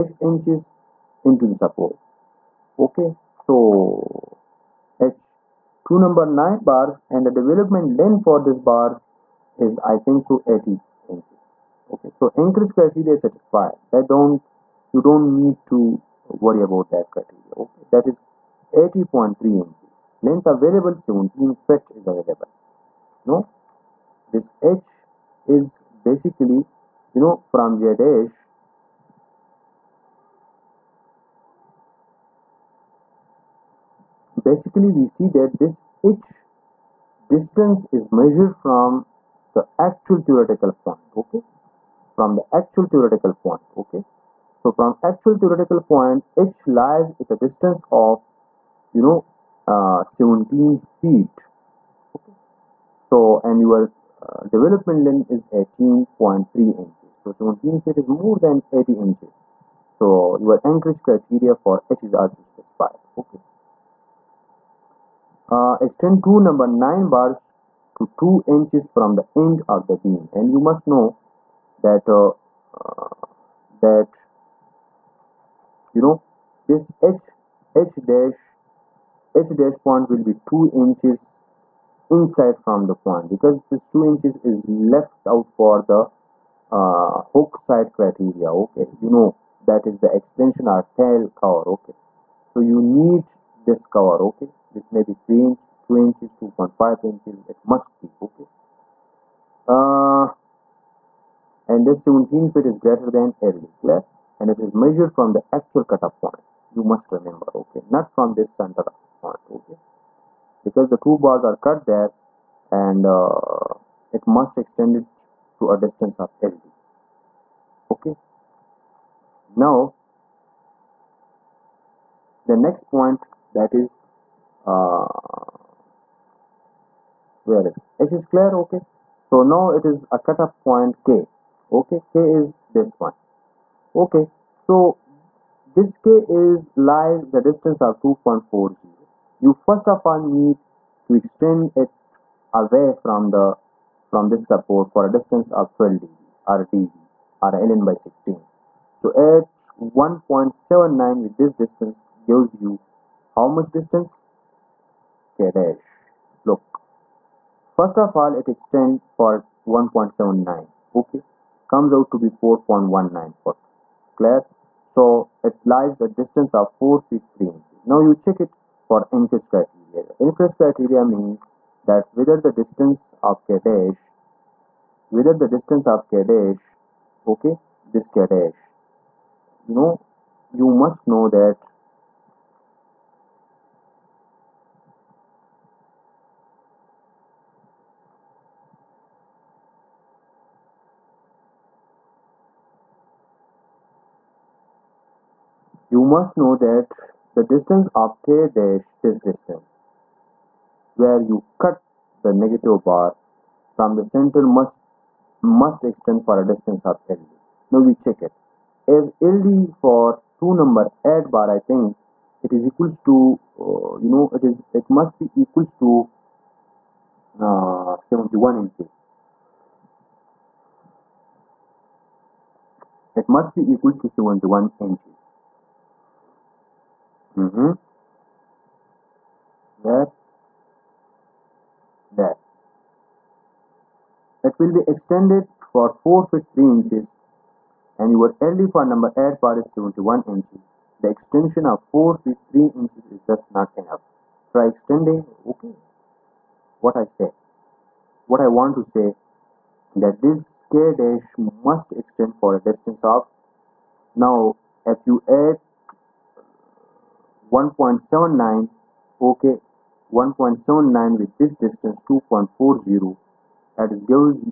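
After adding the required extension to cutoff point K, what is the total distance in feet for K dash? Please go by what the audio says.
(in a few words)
4.19 feet.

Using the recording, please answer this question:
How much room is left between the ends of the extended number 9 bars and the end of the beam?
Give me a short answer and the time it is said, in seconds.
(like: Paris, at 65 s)
2 inches, at 68 s.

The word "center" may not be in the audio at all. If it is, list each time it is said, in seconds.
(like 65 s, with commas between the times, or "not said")
108 s, 204 s.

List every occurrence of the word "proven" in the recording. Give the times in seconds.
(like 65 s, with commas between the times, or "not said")
not said.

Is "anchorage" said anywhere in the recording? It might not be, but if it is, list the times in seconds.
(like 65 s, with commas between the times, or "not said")
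12 s, 60 s.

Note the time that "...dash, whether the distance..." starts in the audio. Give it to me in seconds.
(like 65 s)
173 s.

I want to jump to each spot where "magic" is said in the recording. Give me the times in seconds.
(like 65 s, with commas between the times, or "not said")
not said.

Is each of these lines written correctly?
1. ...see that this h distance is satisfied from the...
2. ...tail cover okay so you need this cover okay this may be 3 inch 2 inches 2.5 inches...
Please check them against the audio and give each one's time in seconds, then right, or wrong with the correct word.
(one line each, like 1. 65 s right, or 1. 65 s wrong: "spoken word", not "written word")
1. 35 s wrong: "measured", not "satisfied"
2. 91 s right.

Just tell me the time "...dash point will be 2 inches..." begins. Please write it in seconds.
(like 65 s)
79 s.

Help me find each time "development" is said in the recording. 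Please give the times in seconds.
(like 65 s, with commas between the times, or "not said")
7 s, 54 s.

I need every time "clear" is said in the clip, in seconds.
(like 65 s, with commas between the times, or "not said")
103 s, 128 s, 164 s.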